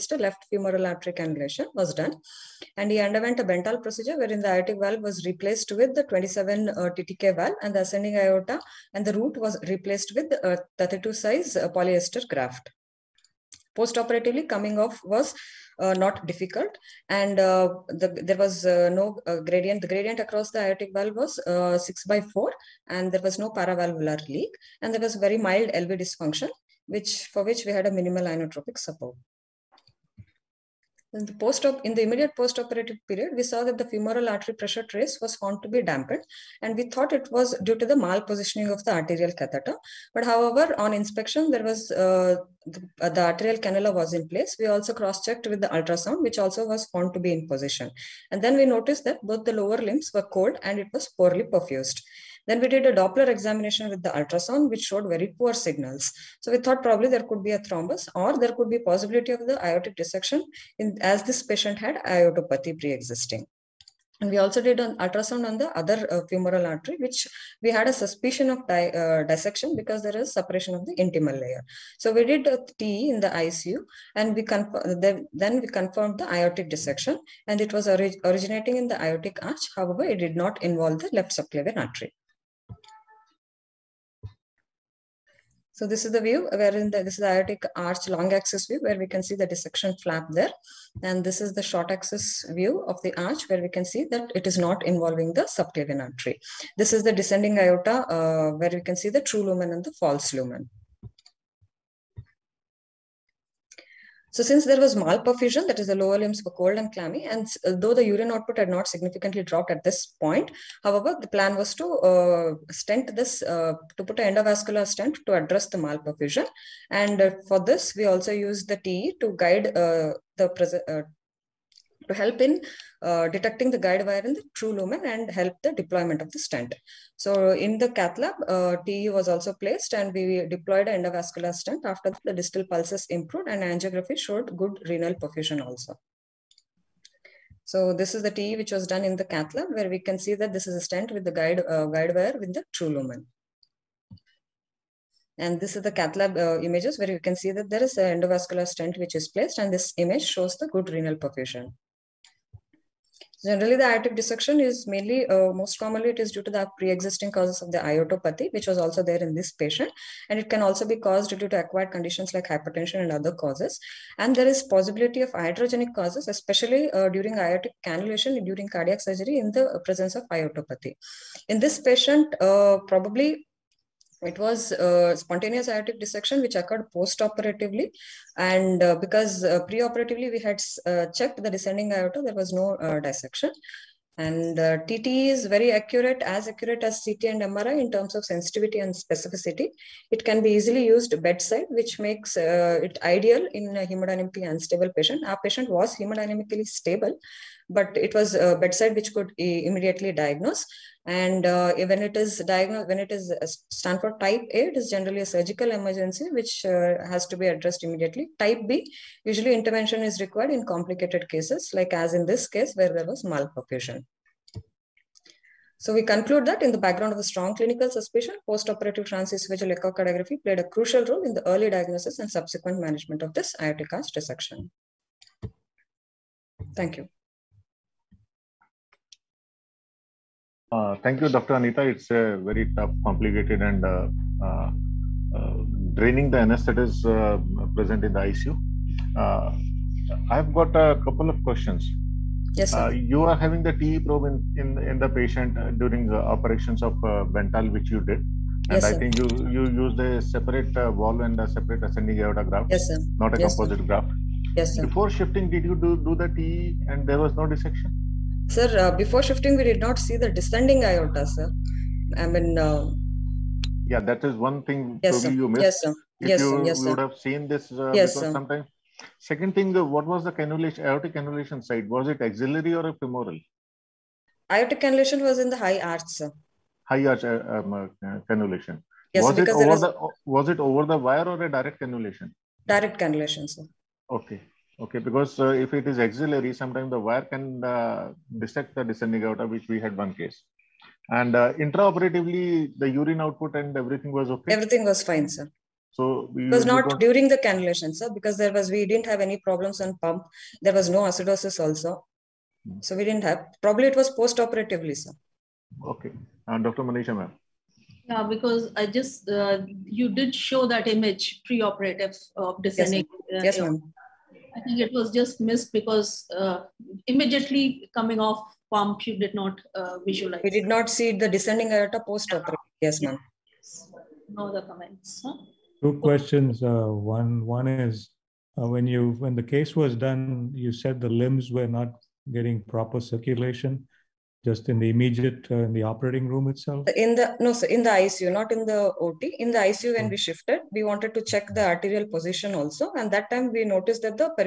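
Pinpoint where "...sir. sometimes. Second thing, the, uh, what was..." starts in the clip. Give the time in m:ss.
4:28.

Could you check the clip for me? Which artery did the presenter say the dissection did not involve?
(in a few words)
left subclavian artery.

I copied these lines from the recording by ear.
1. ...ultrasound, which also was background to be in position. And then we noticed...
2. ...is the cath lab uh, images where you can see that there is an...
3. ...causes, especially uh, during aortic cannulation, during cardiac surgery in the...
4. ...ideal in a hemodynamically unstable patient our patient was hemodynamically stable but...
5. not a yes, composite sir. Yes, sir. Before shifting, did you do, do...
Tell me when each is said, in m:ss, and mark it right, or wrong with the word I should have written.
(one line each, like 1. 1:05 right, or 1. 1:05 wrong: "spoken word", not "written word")
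1. 0:45 wrong: "found", not "background"
2. 2:25 right
3. 2:45 right
4. 3:13 right
5. 4:13 right.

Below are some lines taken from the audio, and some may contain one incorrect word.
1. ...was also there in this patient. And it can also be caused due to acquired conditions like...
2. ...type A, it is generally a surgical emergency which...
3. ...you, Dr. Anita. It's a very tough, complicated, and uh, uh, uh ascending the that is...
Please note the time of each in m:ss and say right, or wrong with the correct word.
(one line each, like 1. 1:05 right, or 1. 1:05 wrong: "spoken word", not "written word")
1. 2:38 right
2. 3:24 right
3. 3:51 wrong: "draining", not "ascending".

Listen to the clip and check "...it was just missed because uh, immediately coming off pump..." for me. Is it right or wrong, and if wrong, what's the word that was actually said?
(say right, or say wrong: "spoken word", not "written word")
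right.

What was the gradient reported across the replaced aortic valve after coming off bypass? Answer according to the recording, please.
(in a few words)
6 by 4.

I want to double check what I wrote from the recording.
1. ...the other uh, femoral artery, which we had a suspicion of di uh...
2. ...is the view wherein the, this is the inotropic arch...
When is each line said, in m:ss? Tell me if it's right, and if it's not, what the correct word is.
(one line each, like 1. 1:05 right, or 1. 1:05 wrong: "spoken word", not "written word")
1. 1:05 right
2. 1:26 wrong: "aortic", not "inotropic".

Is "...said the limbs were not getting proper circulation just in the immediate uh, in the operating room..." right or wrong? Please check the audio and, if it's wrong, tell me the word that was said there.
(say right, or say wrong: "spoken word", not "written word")
right.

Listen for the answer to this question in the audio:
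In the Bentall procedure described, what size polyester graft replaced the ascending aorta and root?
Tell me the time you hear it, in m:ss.
0:10.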